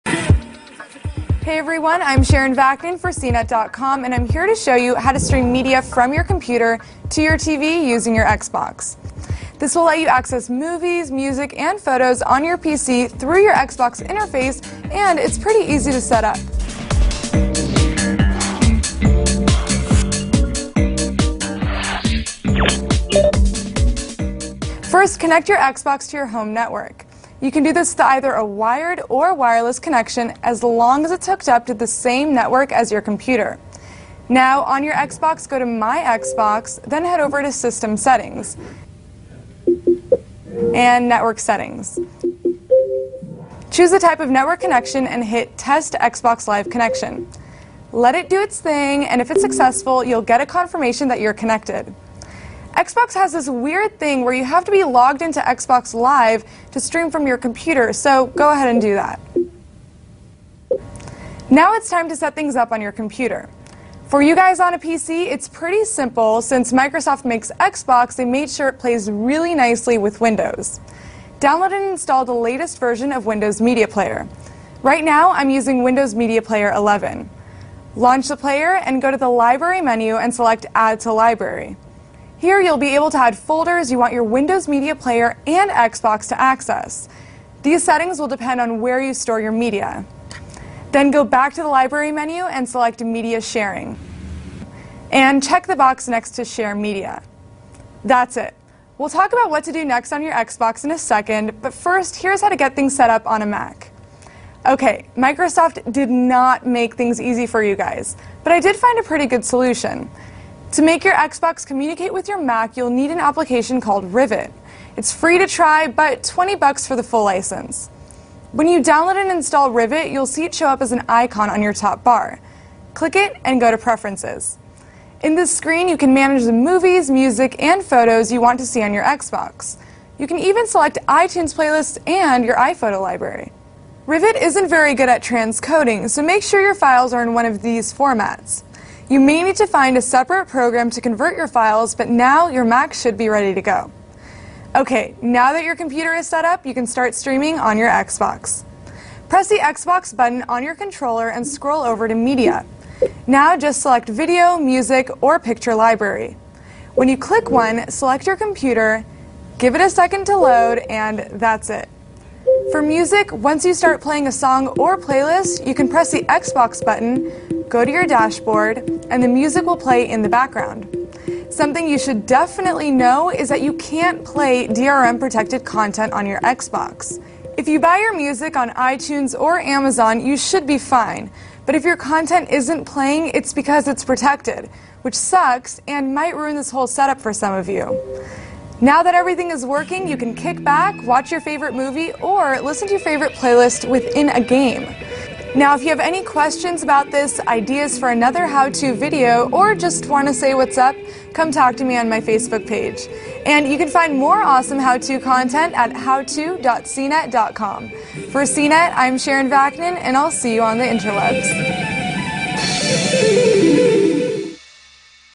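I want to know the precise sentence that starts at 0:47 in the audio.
Let it do its thing, and if it's successful, you'll get a confirmation that you're connected.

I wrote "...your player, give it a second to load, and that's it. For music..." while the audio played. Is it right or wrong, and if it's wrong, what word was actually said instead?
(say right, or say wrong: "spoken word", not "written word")
wrong: "computer", not "player".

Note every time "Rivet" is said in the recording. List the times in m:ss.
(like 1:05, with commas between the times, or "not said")
1:54, 1:59, 2:14.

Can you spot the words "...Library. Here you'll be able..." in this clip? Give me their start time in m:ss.
1:21.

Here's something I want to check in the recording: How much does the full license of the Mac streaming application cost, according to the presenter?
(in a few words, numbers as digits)
$20.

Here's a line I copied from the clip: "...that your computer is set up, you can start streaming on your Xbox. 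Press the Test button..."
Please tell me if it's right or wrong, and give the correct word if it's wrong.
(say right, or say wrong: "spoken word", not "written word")
wrong: "Xbox", not "Test".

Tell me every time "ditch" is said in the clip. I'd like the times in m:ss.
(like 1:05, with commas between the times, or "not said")
not said.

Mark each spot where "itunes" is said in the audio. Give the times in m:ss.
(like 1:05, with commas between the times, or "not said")
2:11, 2:58.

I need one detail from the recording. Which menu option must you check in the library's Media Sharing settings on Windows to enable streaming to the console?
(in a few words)
Share Media.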